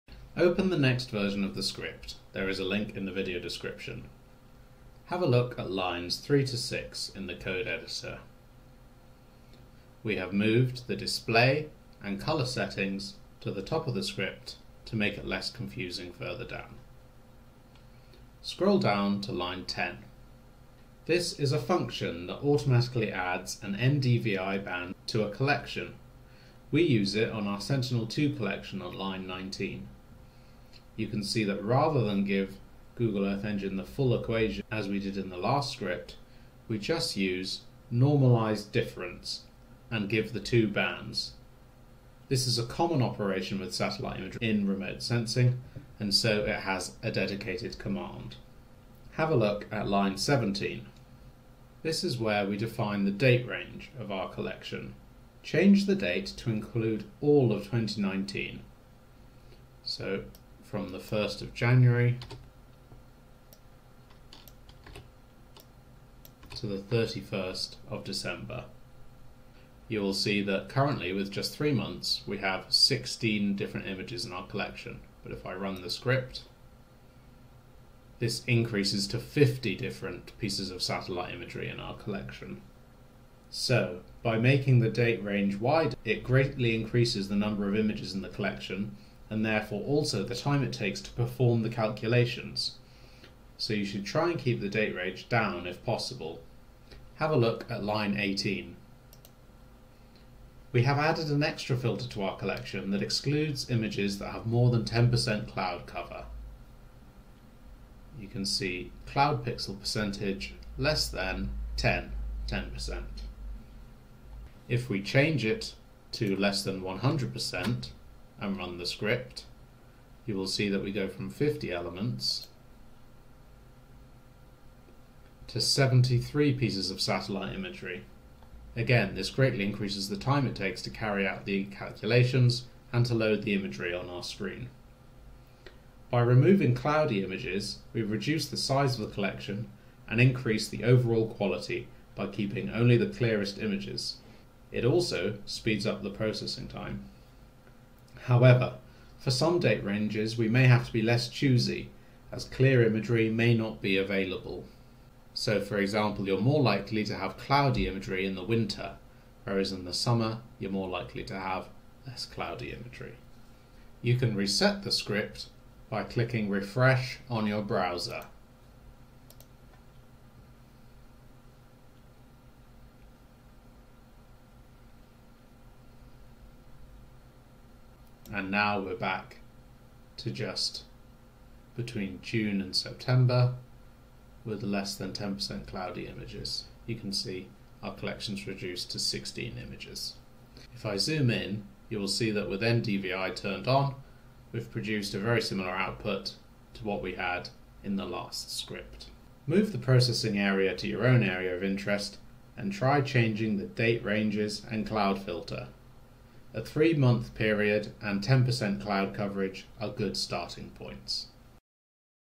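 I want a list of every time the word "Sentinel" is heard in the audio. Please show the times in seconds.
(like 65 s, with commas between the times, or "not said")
27 s.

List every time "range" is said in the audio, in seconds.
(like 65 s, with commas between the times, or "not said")
53 s, 85 s, 94 s, 149 s, 204 s.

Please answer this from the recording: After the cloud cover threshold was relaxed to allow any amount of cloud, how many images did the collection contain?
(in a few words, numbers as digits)
73.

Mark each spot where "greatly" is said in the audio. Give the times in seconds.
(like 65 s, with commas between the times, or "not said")
86 s, 129 s.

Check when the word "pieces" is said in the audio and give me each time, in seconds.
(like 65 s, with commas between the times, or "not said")
80 s, 126 s.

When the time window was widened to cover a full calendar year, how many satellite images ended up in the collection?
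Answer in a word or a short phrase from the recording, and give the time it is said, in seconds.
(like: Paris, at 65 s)
50, at 79 s.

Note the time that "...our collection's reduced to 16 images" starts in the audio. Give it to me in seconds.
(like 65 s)
187 s.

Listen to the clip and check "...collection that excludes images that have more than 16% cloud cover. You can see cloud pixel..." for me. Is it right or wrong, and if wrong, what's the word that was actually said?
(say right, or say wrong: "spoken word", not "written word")
wrong: "10", not "16".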